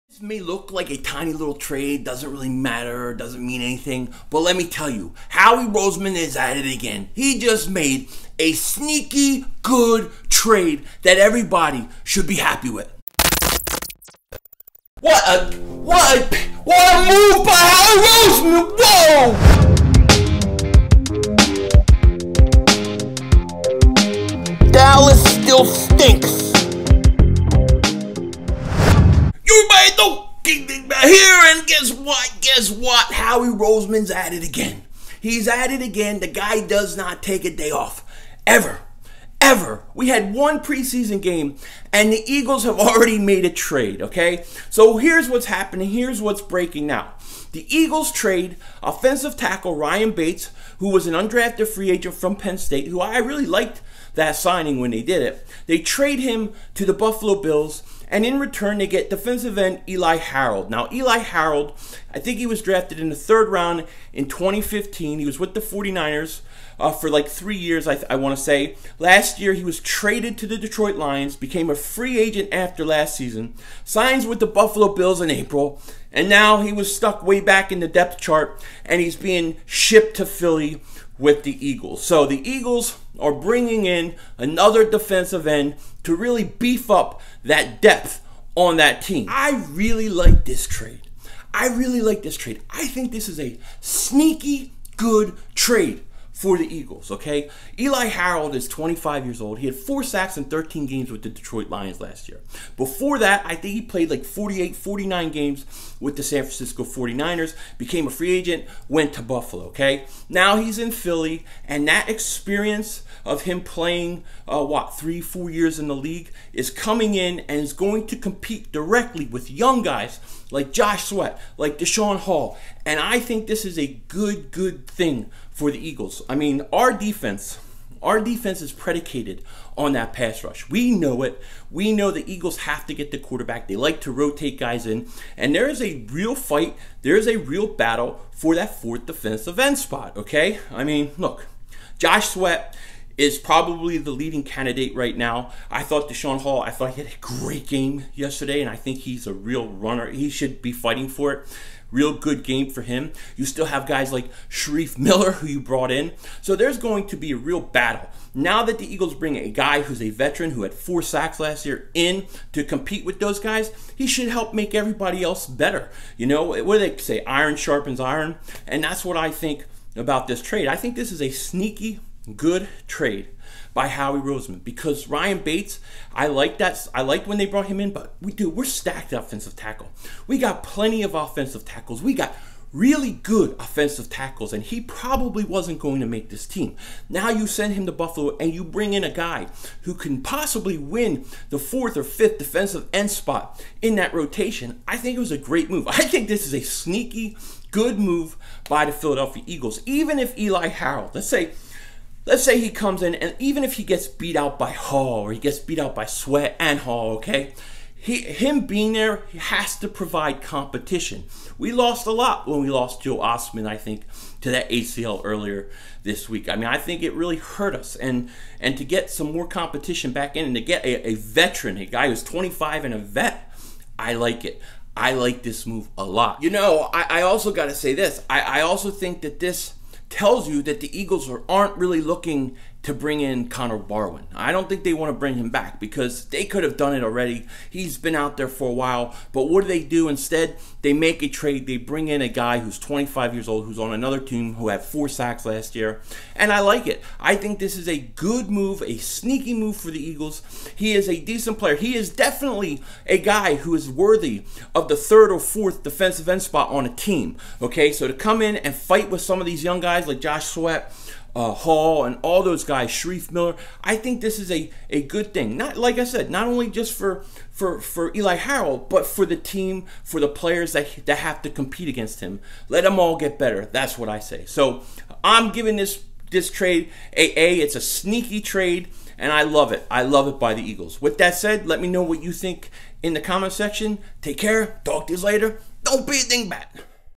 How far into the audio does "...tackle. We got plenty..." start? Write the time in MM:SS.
02:59.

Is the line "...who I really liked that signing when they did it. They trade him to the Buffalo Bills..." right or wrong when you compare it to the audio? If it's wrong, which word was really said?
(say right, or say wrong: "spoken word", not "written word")
right.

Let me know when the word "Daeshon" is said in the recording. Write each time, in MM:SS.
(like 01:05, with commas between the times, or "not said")
02:01, 02:26.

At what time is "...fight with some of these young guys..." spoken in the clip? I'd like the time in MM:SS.
04:18.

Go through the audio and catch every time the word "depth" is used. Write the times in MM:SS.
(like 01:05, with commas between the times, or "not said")
01:17, 01:27.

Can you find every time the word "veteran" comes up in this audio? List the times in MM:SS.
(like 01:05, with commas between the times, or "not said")
02:40, 03:41.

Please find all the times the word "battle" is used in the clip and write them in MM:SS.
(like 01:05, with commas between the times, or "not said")
02:17, 02:37.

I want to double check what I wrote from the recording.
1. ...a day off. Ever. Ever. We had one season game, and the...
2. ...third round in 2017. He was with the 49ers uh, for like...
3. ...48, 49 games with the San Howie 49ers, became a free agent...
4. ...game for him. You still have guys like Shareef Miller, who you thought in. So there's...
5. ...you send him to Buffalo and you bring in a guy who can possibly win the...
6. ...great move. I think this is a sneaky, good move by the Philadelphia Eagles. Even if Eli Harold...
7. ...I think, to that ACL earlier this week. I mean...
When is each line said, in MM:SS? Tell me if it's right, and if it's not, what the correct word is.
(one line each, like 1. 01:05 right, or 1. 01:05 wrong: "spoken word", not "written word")
1. 00:37 wrong: "preseason", not "season"
2. 01:03 wrong: "2015", not "2017"
3. 01:44 wrong: "Francisco", not "Howie"
4. 02:32 wrong: "brought", not "thought"
5. 03:07 right
6. 03:15 right
7. 03:33 right.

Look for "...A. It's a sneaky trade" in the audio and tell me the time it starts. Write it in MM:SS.
04:37.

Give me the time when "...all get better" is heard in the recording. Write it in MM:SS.
04:32.